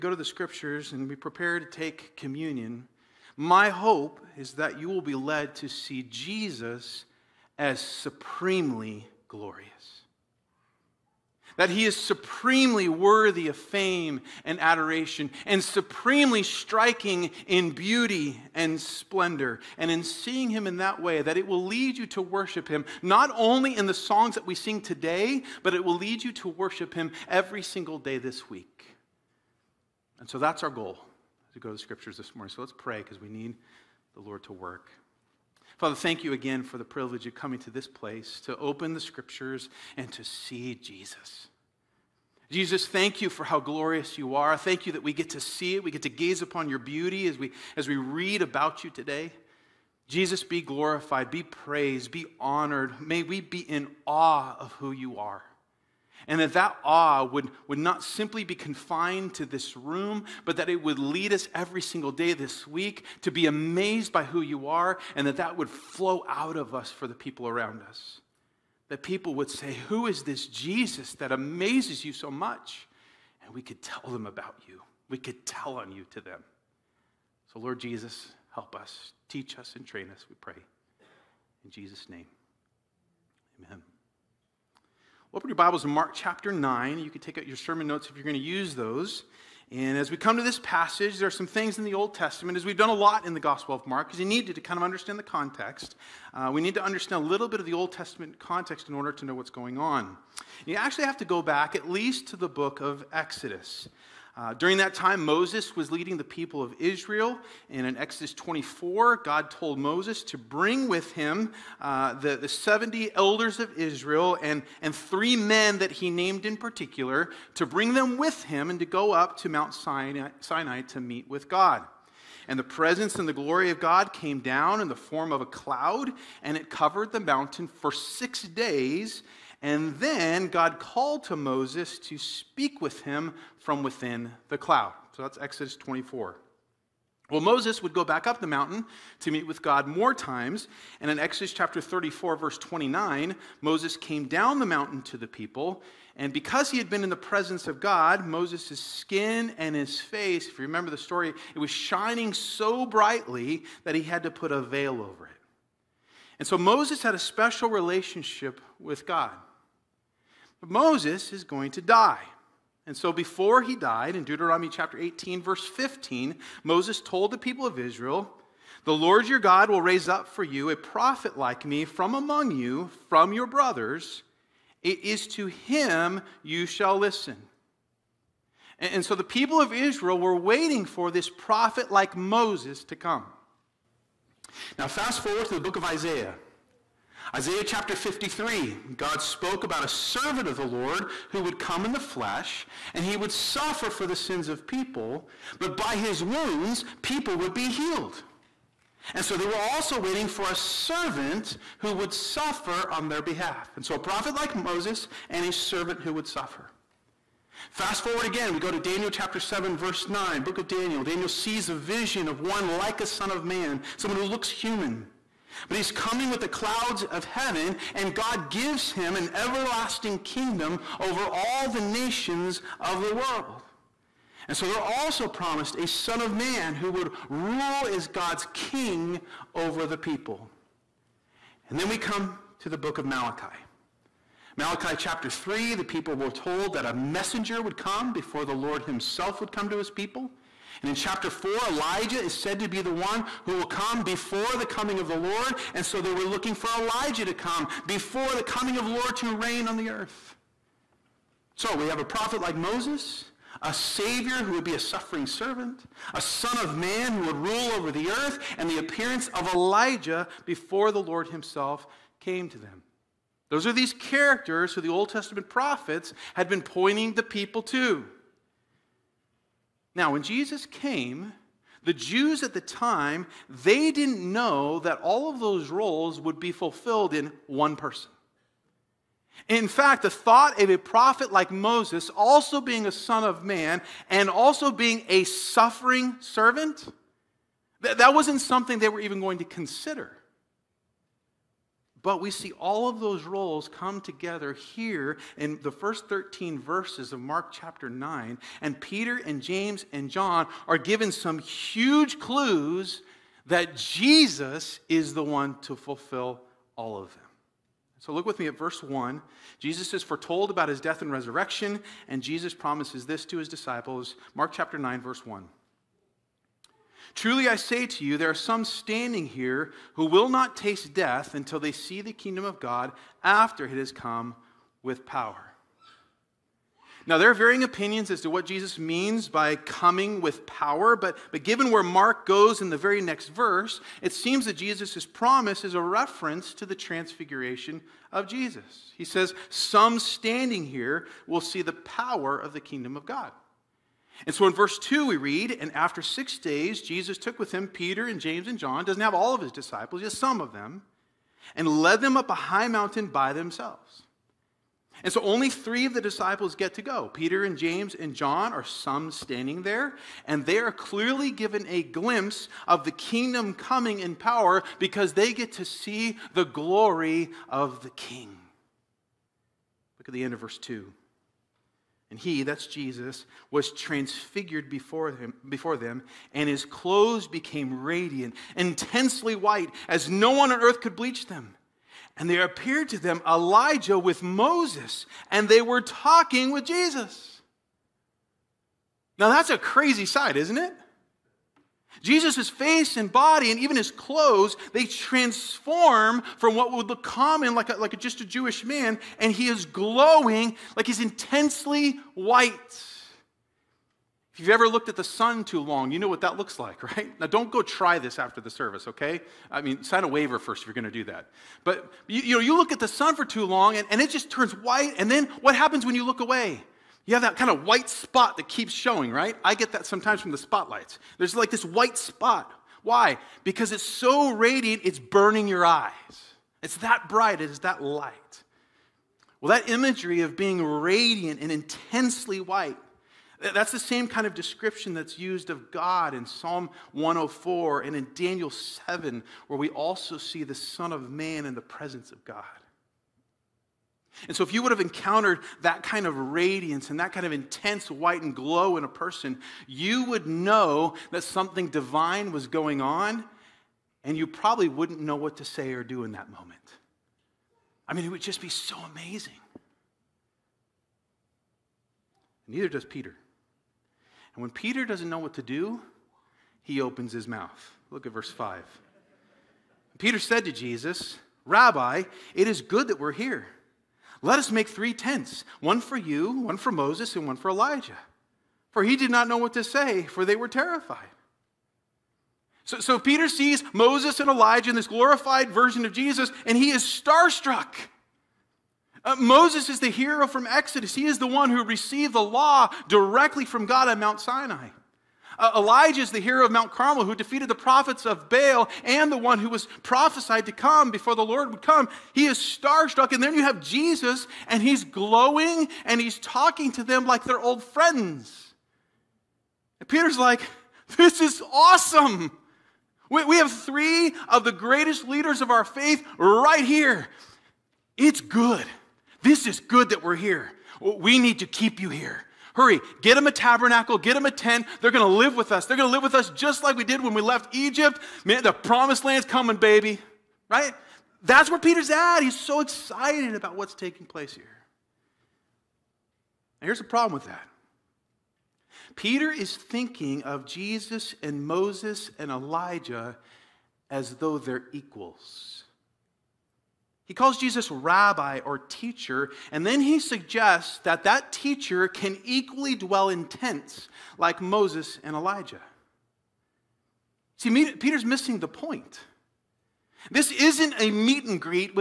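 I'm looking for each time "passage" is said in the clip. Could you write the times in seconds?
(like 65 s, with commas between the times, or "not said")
90 s.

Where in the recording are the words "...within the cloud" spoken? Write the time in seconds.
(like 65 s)
133 s.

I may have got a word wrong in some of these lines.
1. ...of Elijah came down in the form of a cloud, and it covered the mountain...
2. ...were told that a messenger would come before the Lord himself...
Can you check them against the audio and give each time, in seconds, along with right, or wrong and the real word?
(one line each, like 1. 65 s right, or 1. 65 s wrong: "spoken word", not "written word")
1. 123 s wrong: "God", not "Elijah"
2. 236 s right.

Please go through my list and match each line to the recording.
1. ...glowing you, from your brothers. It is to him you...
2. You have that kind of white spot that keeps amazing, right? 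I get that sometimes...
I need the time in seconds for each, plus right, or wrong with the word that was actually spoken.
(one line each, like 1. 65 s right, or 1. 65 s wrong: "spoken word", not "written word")
1. 172 s wrong: "among", not "glowing"
2. 417 s wrong: "showing", not "amazing".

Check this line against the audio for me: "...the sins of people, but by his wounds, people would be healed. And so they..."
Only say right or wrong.
right.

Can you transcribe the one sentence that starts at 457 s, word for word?
I mean, it would just be so amazing.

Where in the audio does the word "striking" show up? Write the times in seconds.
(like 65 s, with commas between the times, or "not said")
16 s.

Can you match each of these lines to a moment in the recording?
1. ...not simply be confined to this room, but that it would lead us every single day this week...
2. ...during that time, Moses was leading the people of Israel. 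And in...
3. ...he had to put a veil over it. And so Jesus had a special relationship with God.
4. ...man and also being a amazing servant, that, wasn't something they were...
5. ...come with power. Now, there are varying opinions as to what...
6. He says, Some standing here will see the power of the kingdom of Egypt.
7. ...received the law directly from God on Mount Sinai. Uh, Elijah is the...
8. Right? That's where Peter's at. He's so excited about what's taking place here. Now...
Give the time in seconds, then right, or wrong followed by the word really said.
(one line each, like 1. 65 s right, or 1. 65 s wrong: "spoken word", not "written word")
1. 57 s right
2. 104 s right
3. 153 s wrong: "Moses", not "Jesus"
4. 283 s wrong: "suffering", not "amazing"
5. 323 s right
6. 338 s wrong: "God", not "Egypt"
7. 491 s right
8. 530 s right.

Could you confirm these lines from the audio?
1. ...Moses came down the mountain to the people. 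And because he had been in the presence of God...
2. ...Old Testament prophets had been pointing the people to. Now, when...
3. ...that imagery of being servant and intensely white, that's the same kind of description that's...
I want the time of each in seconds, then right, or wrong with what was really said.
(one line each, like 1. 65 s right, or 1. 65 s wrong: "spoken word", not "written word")
1. 143 s right
2. 264 s right
3. 429 s wrong: "radiant", not "servant".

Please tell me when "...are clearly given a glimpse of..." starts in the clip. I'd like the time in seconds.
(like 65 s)
360 s.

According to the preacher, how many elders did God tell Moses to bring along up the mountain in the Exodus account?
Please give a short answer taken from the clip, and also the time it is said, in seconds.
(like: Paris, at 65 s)
70, at 112 s.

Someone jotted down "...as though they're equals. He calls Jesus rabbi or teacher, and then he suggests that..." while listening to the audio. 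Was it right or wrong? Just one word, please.
right.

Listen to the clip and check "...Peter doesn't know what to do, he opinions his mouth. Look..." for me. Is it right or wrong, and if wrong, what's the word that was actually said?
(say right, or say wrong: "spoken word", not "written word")
wrong: "opens", not "opinions".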